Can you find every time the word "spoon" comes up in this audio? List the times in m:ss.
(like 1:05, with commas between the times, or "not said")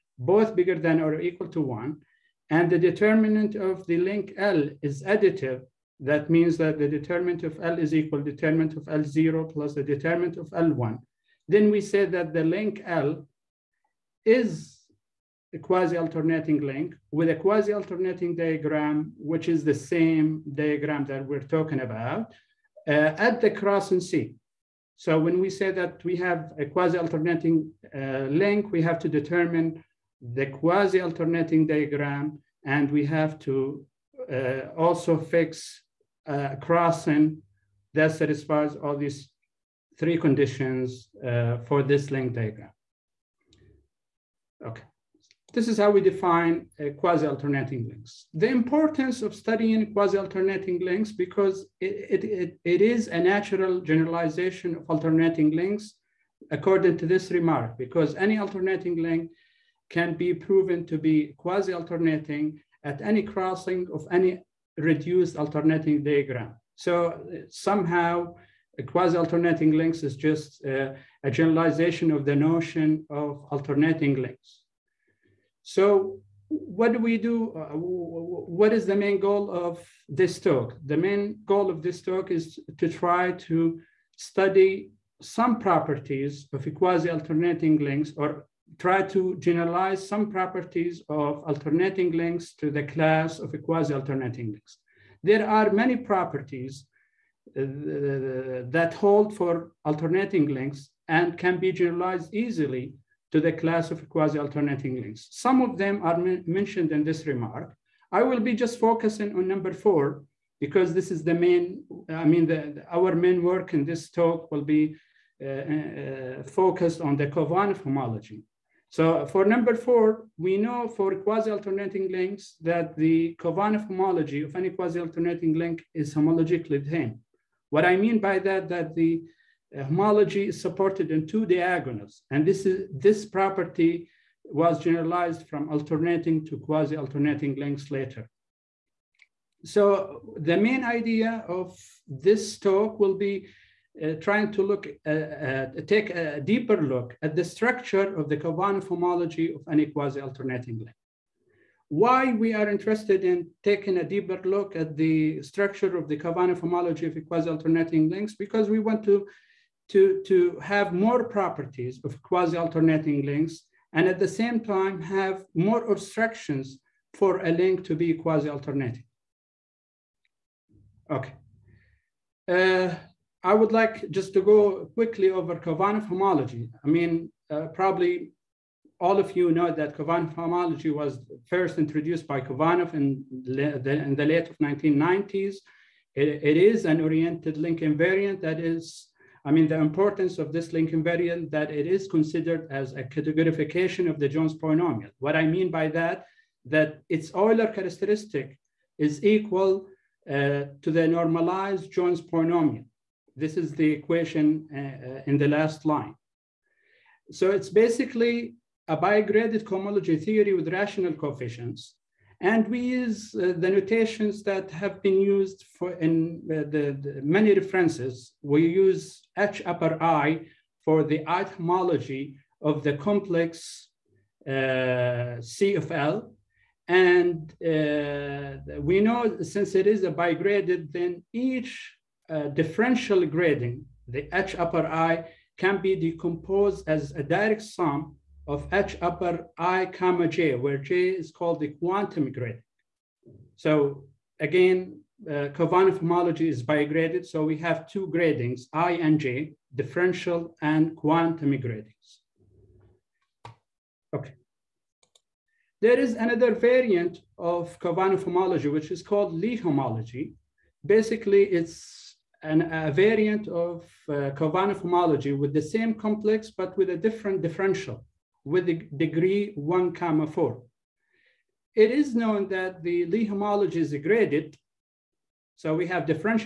not said.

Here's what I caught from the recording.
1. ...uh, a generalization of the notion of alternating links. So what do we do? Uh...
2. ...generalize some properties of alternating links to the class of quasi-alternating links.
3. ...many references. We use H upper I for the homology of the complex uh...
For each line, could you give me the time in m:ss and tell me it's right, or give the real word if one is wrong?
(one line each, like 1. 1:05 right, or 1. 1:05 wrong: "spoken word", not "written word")
1. 1:10 right
2. 1:29 right
3. 3:37 wrong: "etymology", not "homology".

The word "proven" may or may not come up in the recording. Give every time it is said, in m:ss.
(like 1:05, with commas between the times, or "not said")
1:00.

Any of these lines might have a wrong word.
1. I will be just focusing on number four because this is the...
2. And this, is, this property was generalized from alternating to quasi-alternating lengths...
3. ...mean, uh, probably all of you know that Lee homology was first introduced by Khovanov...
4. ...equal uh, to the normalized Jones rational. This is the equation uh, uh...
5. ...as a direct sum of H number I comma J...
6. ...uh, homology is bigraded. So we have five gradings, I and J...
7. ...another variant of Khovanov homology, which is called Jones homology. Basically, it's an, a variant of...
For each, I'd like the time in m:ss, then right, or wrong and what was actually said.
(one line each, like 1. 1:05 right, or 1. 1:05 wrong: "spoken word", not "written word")
1. 1:48 right
2. 2:12 right
3. 2:56 wrong: "Khovanov", not "Lee"
4. 3:19 wrong: "polynomial", not "rational"
5. 3:56 wrong: "upper", not "number"
6. 4:05 wrong: "two", not "five"
7. 4:16 wrong: "Lee", not "Jones".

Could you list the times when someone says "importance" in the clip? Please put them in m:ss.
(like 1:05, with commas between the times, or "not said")
0:48, 3:09.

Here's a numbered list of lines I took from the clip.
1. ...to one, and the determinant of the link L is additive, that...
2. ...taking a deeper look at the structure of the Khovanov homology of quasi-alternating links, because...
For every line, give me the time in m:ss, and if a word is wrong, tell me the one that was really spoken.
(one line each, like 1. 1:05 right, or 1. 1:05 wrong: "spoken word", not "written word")
1. 0:01 right
2. 2:33 right.